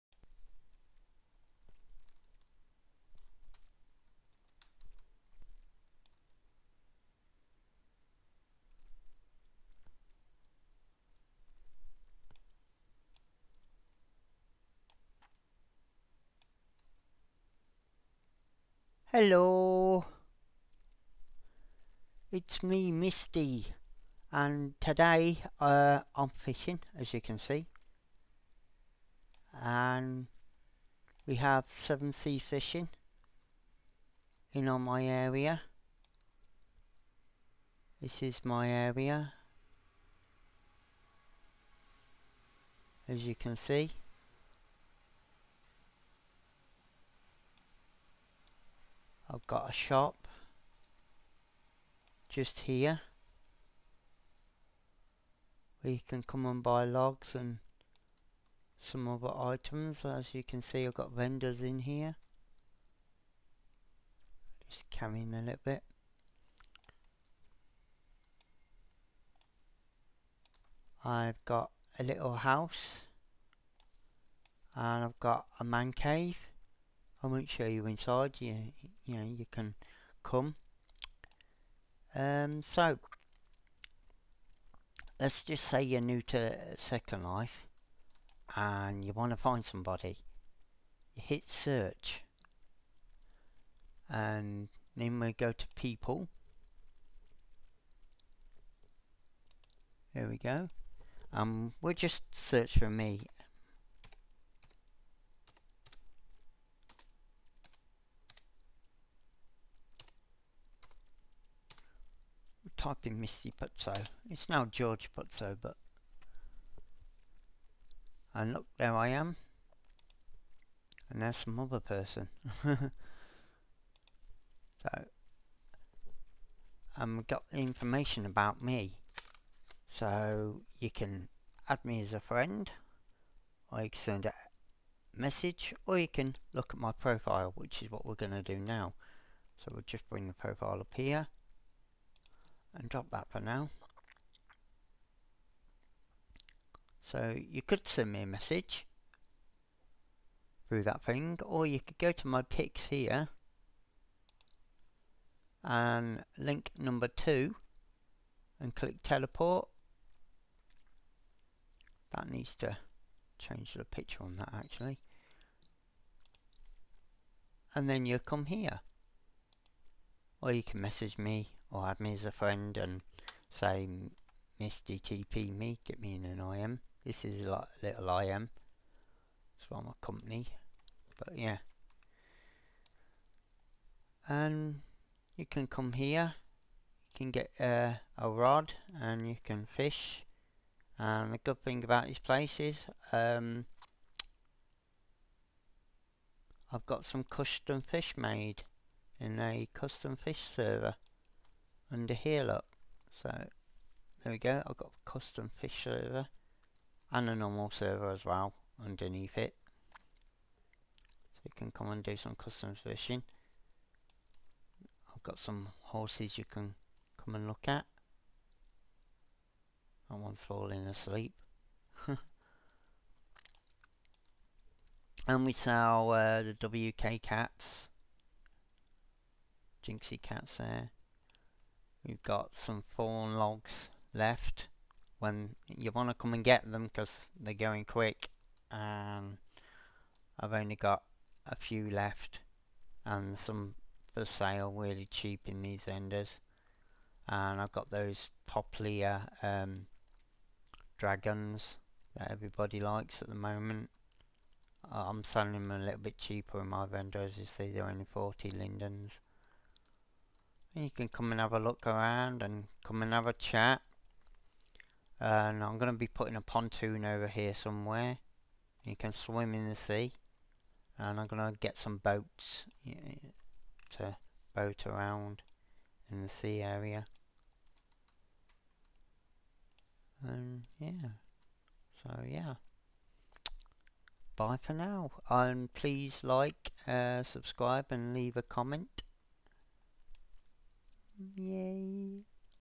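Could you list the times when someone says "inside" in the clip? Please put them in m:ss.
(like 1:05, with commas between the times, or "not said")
1:17.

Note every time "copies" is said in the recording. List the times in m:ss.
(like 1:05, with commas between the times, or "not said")
not said.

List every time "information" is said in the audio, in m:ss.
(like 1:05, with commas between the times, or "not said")
2:07.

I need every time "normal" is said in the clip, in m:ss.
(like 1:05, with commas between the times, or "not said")
3:27.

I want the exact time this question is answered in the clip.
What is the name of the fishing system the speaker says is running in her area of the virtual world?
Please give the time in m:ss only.
0:31.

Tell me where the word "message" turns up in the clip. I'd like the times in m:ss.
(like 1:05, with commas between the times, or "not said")
2:15, 2:28, 2:50.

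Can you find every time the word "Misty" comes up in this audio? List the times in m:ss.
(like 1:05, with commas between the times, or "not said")
0:22, 1:53, 2:54.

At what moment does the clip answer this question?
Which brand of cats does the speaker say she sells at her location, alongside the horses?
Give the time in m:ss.
3:49.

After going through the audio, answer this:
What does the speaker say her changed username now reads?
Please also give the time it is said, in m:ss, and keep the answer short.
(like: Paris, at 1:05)
George Putzo, at 1:54.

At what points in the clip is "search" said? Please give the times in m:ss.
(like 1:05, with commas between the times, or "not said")
1:31, 1:42.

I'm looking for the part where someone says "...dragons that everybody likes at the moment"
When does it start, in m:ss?
4:10.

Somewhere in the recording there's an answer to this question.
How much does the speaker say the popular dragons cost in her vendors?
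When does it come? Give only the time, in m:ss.
4:18.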